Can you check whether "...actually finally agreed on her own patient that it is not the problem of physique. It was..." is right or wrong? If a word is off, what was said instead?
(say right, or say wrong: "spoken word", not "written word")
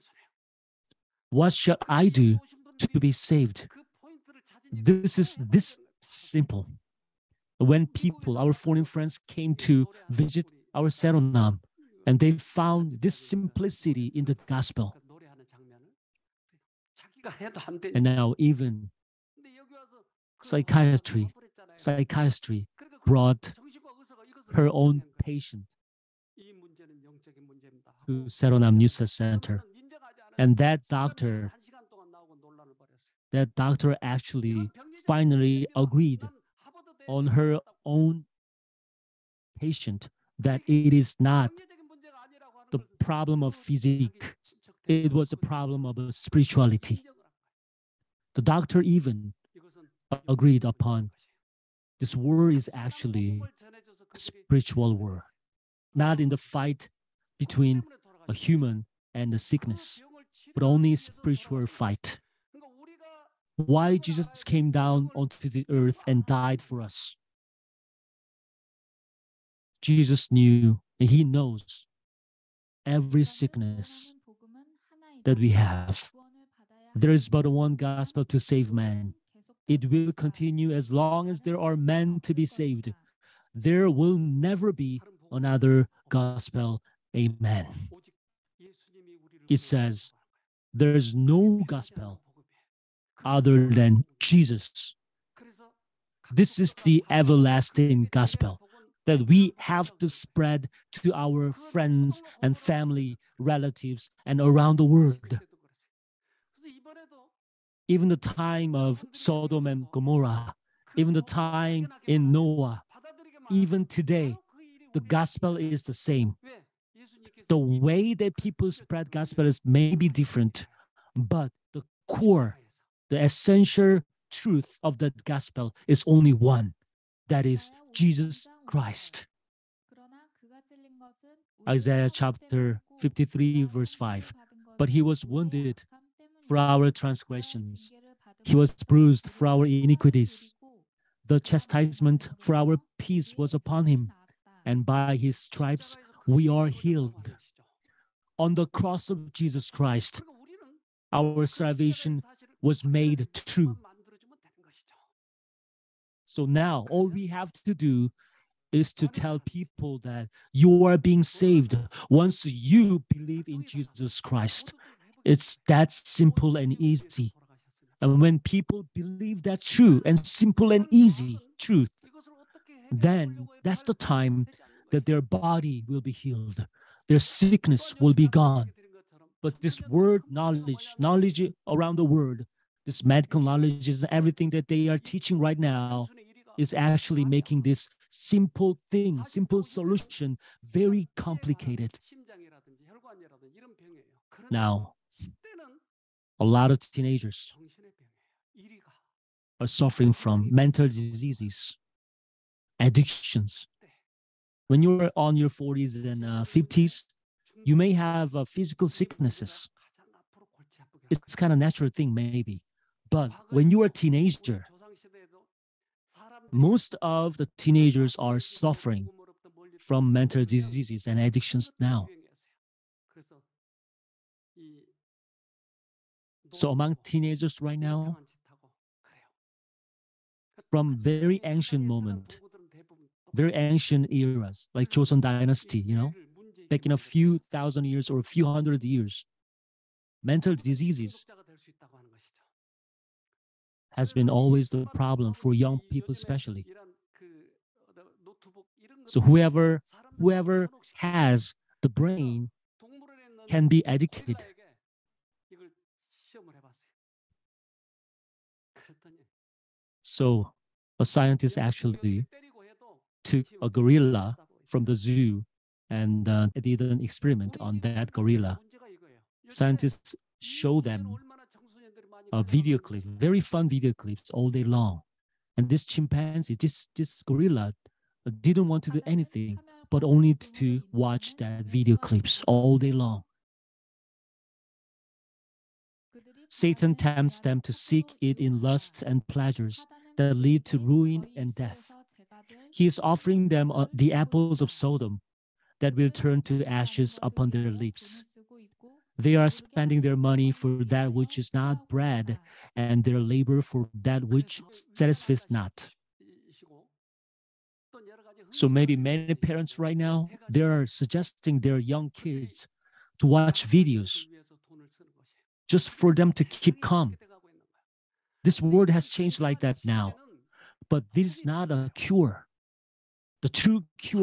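right.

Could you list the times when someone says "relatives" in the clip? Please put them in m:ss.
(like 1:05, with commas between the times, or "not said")
1:43.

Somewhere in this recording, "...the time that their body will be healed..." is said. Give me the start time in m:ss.
2:53.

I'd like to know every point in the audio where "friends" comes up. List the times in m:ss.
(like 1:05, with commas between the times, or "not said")
0:08, 1:41.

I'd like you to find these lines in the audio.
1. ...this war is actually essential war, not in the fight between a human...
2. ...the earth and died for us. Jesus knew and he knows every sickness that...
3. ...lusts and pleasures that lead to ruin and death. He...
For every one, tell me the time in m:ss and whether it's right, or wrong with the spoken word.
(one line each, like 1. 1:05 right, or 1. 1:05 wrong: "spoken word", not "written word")
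1. 0:51 wrong: "spiritual", not "essential"
2. 1:05 right
3. 4:48 right.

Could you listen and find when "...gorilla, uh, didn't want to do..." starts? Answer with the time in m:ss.
4:37.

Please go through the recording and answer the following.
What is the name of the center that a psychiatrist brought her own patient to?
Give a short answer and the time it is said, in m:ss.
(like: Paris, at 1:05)
Saeronam NEWSTART Center, at 0:28.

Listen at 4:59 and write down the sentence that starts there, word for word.
They are spending their money for that which is not bread, and their labor for that which satisfies not.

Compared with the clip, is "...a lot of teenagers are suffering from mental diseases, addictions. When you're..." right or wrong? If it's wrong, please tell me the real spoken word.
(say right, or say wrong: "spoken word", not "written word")
right.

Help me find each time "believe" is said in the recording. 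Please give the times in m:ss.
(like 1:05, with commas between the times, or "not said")
2:43, 2:48.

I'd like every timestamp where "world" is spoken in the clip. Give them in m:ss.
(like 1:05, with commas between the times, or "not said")
1:44, 3:02, 5:18.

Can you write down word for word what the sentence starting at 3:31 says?
It's kind of natural thing, maybe.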